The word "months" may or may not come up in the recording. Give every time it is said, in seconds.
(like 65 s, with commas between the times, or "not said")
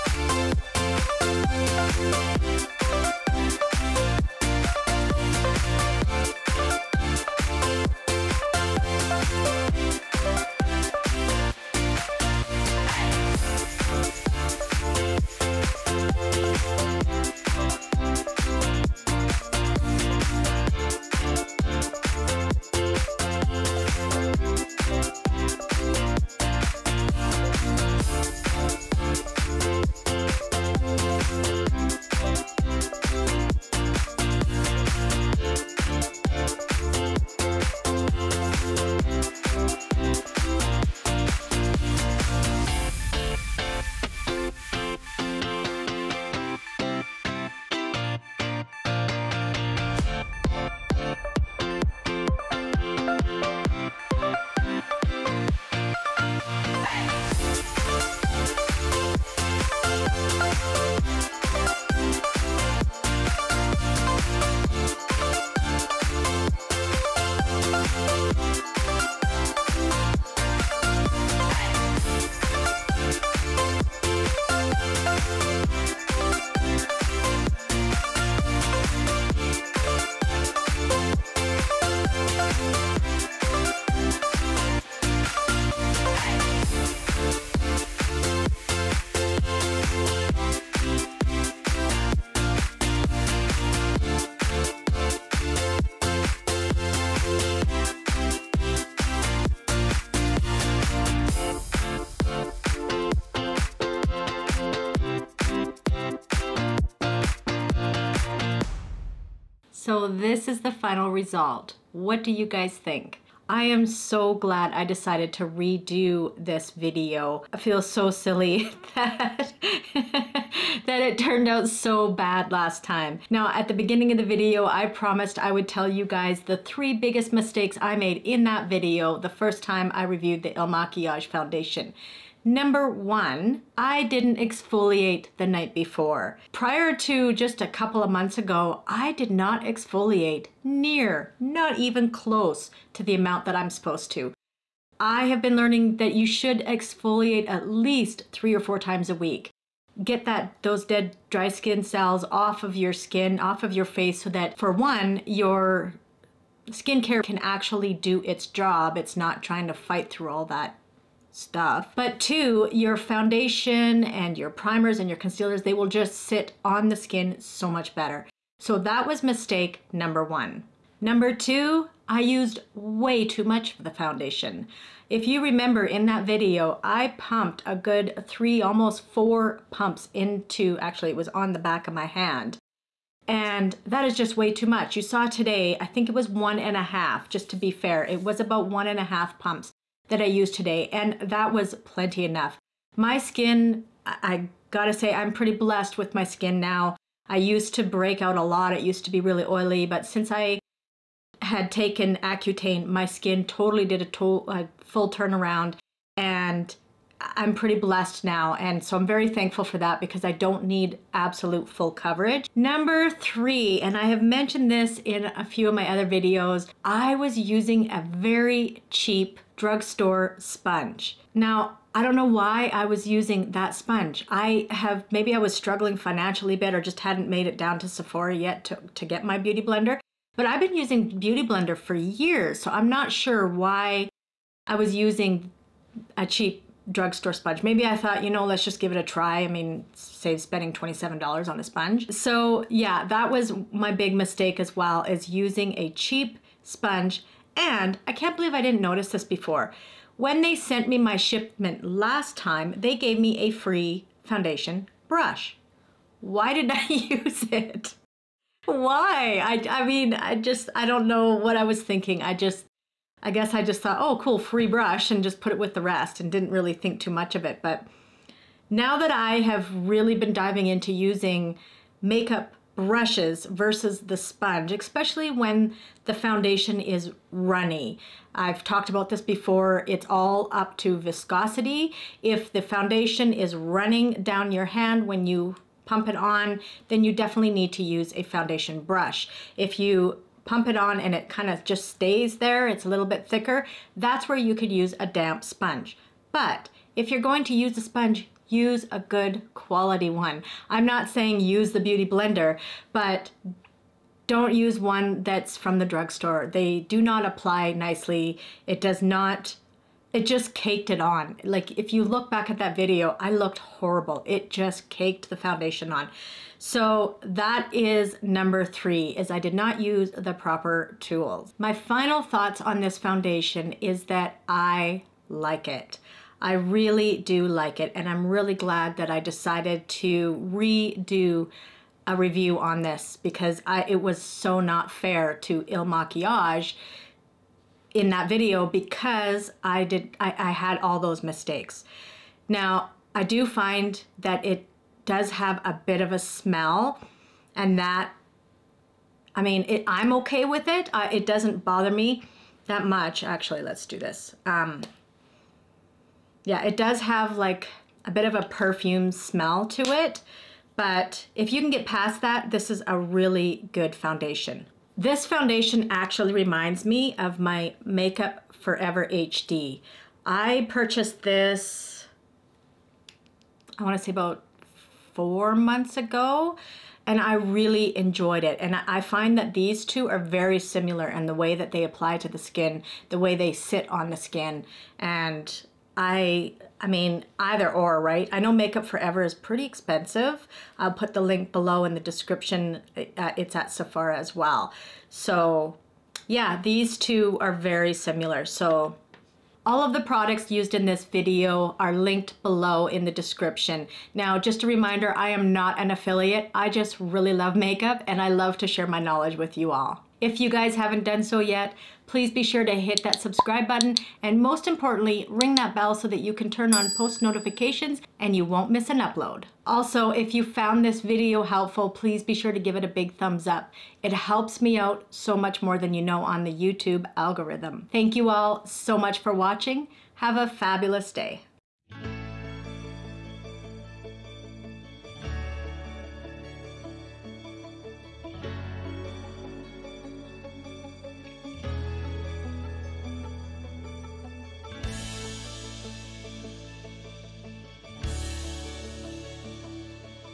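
138 s, 375 s.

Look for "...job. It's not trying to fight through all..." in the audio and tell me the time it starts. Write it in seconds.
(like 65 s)
158 s.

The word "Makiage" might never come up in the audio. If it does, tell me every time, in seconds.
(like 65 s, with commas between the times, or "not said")
130 s, 335 s.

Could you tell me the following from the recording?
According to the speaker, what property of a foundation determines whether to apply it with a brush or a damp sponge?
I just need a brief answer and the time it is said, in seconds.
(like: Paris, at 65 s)
viscosity, at 280 s.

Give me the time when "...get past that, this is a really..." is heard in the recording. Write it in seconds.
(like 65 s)
361 s.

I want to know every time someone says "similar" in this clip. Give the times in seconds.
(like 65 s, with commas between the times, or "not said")
380 s, 397 s.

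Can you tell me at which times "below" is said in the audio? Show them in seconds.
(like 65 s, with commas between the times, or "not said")
391 s, 402 s.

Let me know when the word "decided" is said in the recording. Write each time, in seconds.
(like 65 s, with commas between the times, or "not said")
114 s, 329 s.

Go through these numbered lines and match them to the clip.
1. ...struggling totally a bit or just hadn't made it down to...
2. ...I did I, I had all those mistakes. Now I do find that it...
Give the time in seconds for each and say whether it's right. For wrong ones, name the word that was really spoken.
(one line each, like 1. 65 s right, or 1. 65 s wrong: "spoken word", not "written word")
1. 225 s wrong: "financially", not "totally"
2. 339 s right.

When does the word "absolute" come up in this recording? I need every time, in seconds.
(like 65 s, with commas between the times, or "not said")
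211 s.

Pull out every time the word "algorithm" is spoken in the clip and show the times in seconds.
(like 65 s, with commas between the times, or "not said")
427 s.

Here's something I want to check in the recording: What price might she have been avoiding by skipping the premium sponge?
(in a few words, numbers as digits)
$27.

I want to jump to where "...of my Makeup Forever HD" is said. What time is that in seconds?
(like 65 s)
367 s.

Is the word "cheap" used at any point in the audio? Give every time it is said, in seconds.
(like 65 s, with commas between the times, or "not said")
218 s, 236 s, 245 s.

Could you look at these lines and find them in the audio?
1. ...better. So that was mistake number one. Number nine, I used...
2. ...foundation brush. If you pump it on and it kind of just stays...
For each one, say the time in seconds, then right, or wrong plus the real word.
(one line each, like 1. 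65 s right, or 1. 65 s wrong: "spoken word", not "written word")
1. 167 s wrong: "two", not "nine"
2. 288 s right.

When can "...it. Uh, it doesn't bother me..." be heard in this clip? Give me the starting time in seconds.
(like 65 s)
350 s.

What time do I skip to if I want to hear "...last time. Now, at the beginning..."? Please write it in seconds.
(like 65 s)
122 s.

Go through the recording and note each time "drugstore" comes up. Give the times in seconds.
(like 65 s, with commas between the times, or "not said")
219 s, 236 s, 305 s.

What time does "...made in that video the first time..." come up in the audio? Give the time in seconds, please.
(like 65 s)
127 s.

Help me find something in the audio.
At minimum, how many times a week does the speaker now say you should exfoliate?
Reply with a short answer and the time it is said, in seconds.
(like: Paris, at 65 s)
3 or 4, at 148 s.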